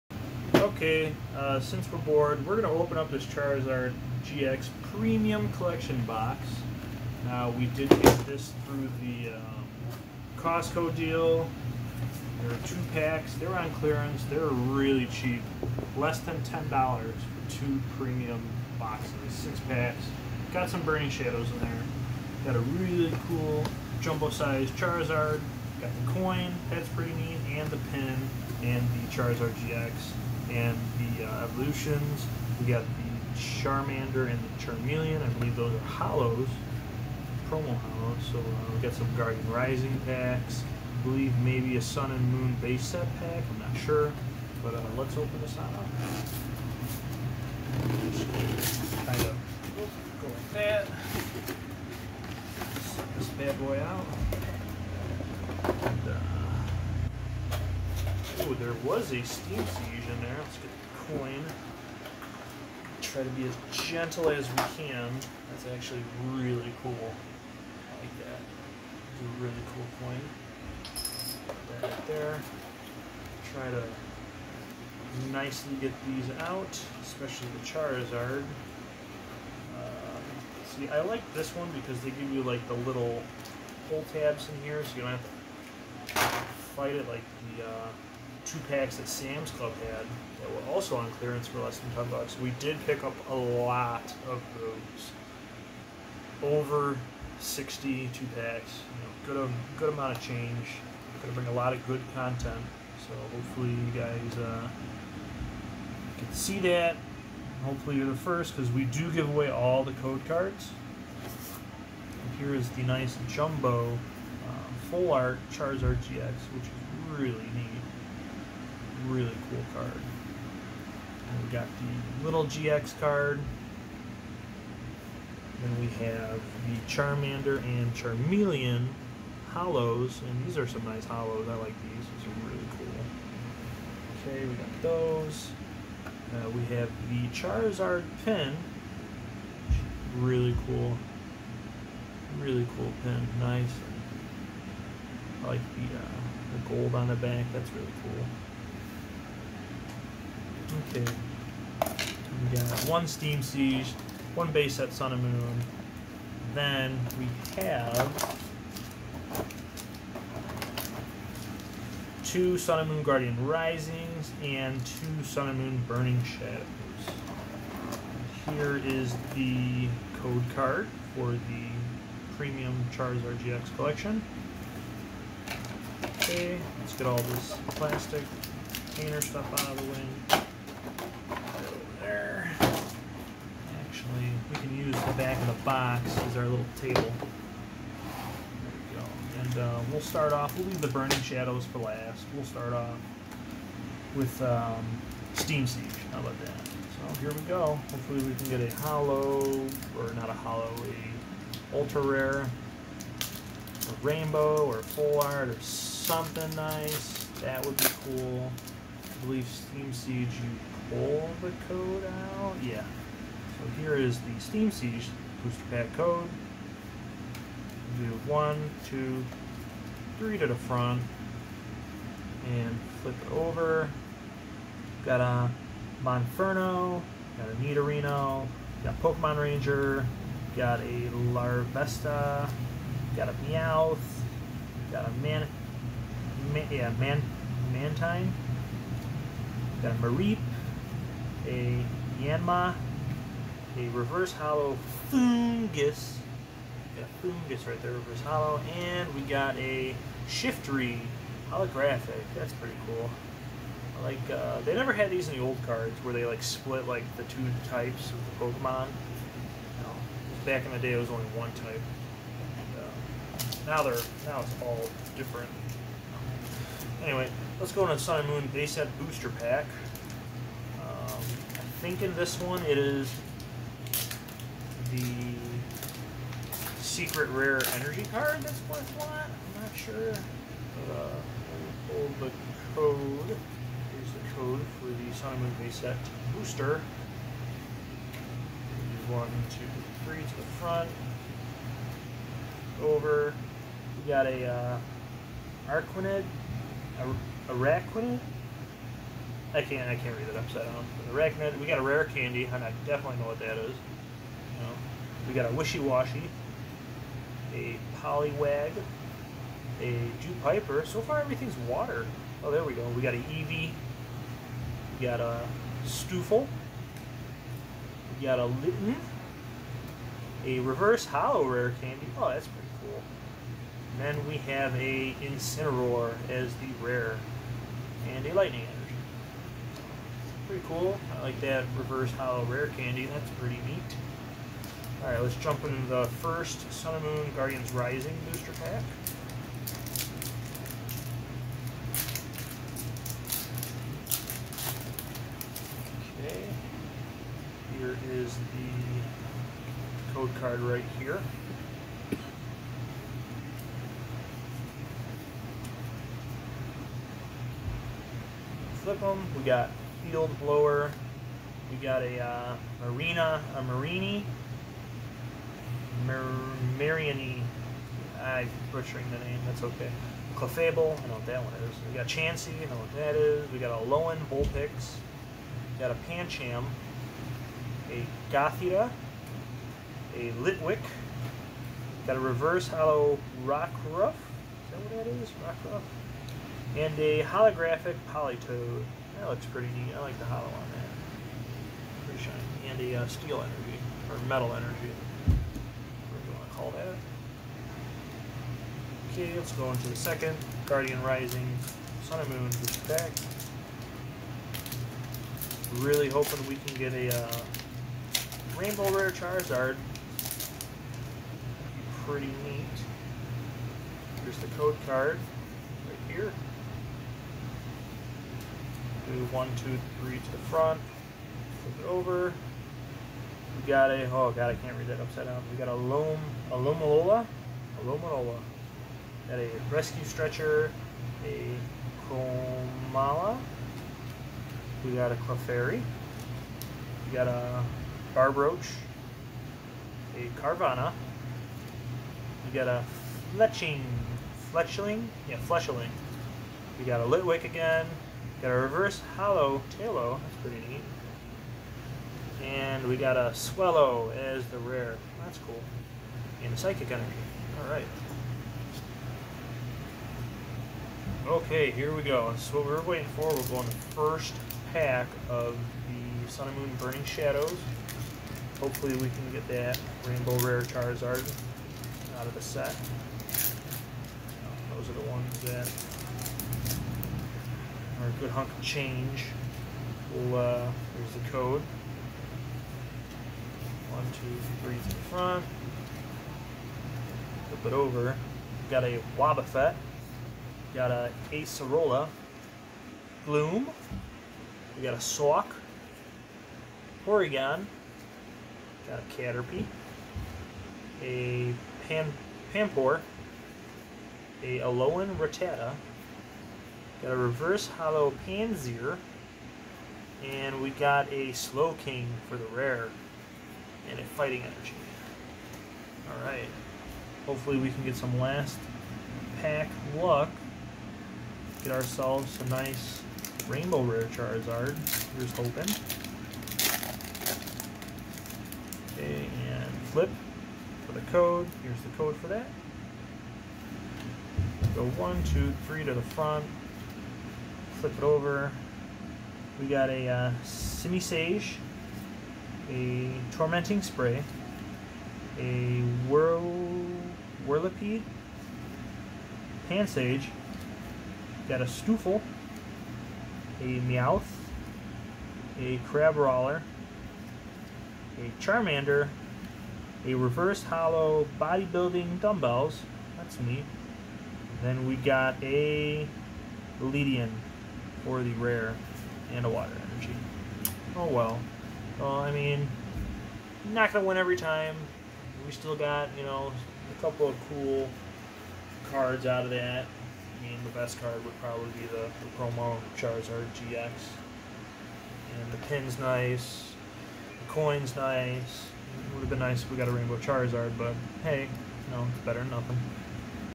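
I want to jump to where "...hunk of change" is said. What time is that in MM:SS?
07:58.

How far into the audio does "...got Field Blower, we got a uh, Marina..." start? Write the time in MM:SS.
05:59.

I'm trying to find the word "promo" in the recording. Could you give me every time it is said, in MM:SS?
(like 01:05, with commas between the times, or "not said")
00:37, 09:42.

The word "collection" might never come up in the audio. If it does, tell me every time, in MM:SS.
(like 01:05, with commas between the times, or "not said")
00:05, 02:53.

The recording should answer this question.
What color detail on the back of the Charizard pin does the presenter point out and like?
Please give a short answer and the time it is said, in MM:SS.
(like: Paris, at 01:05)
Gold, at 02:26.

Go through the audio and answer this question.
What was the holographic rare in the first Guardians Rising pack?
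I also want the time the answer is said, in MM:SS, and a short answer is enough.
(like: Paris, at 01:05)
Politoed, at 06:28.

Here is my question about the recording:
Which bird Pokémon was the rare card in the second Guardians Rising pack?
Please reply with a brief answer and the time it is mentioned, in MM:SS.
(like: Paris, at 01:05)
Swellow, at 07:33.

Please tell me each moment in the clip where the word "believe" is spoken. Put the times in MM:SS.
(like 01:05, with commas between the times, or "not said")
00:35, 00:41, 03:29.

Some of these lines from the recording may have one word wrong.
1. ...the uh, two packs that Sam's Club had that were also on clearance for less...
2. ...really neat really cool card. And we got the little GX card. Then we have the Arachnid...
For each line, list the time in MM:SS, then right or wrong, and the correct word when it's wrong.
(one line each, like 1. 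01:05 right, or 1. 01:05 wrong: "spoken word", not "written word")
1. 01:27 right
2. 01:57 wrong: "Charmander", not "Arachnid".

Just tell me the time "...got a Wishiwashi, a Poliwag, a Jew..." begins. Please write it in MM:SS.
05:05.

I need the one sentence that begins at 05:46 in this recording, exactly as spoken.
Okay, here is the code card right here.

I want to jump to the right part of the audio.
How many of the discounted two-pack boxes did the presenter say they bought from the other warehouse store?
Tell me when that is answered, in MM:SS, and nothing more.
01:36.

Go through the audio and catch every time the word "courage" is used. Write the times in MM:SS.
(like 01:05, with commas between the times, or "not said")
not said.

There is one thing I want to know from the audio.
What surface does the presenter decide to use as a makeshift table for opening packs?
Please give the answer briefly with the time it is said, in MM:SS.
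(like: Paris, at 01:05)
The back of the box, at 03:05.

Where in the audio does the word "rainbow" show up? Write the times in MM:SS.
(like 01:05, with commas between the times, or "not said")
03:24, 06:48, 07:50, 08:43, 09:49.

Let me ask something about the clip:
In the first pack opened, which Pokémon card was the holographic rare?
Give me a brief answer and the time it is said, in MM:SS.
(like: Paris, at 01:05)
Shiftry, at 04:10.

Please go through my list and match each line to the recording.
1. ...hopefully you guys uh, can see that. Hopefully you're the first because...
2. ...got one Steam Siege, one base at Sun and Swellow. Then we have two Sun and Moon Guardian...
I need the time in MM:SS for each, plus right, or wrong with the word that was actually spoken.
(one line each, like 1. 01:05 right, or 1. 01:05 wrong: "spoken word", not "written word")
1. 01:43 right
2. 02:32 wrong: "Moon", not "Swellow".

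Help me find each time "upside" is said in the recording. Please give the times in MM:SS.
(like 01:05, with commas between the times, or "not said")
05:00, 07:04.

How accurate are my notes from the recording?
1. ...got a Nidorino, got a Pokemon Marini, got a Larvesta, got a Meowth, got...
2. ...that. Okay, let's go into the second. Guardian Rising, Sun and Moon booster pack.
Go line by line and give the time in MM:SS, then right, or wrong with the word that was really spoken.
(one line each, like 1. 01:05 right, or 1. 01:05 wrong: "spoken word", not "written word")
1. 03:47 wrong: "Ranger", not "Marini"
2. 06:36 right.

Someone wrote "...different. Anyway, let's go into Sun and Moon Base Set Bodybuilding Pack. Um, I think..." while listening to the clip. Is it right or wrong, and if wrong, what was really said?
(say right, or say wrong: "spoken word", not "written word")
wrong: "Booster", not "Bodybuilding".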